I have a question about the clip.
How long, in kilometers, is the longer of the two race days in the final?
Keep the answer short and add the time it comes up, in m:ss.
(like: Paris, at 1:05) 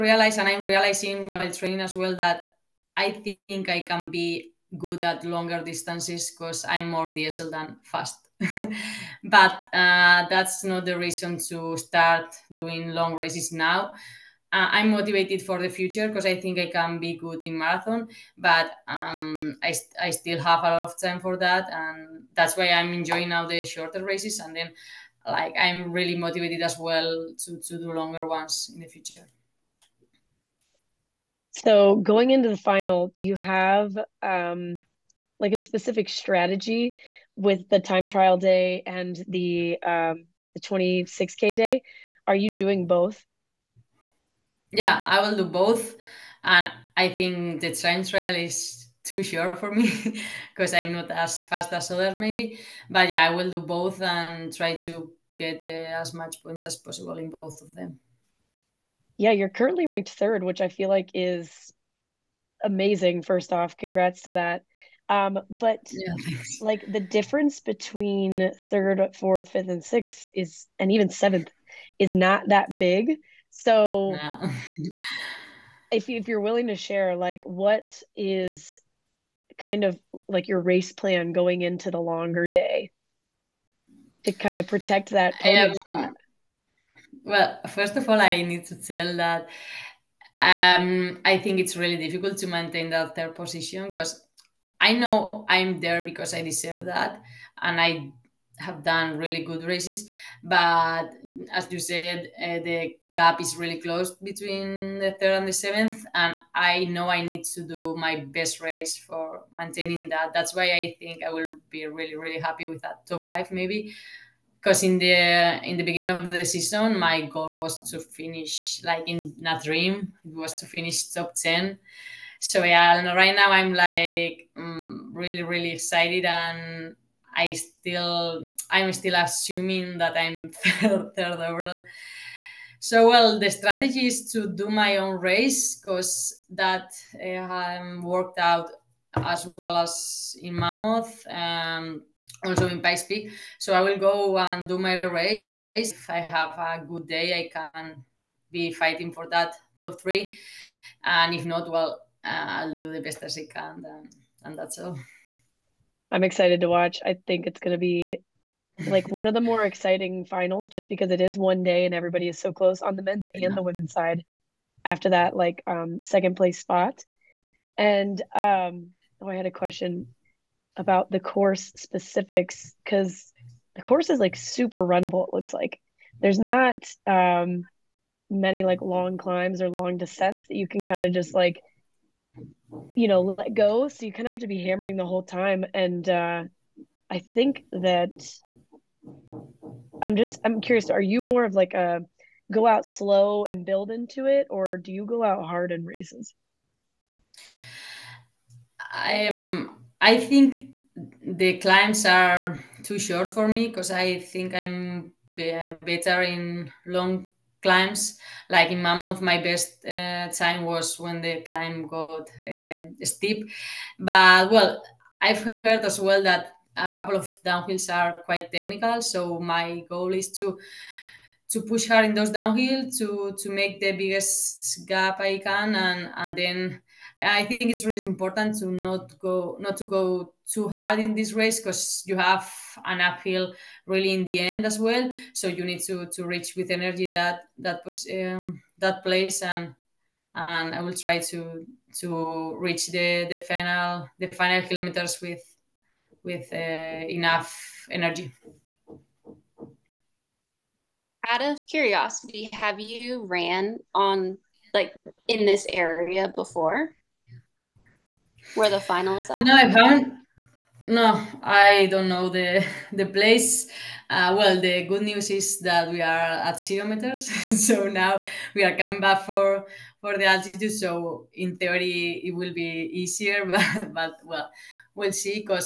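26k, at 0:40.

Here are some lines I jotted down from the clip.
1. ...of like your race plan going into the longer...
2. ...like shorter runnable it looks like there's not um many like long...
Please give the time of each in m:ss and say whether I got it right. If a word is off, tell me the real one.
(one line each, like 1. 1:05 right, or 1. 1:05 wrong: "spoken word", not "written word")
1. 1:19 right
2. 2:54 wrong: "super", not "shorter".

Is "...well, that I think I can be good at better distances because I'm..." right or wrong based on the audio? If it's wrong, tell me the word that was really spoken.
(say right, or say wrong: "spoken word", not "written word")
wrong: "longer", not "better".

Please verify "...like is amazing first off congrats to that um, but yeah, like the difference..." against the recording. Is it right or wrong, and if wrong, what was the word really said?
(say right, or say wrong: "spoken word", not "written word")
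right.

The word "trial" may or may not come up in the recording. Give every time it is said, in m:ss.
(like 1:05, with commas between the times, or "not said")
0:38, 0:48.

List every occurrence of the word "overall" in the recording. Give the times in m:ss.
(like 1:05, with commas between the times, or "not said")
2:11.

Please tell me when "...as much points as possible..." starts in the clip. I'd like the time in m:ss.
0:56.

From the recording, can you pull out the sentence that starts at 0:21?
And that's why I'm enjoying now the shorter races.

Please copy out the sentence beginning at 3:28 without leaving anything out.
Like in Mammoth, my best uh, time was when the climb got uh, steep.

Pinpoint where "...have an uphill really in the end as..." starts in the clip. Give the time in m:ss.
3:52.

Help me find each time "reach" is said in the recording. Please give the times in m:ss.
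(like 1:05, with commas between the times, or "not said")
3:56, 4:02.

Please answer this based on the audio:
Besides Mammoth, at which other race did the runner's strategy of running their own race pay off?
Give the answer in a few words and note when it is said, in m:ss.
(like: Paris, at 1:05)
Pikes Peak, at 2:22.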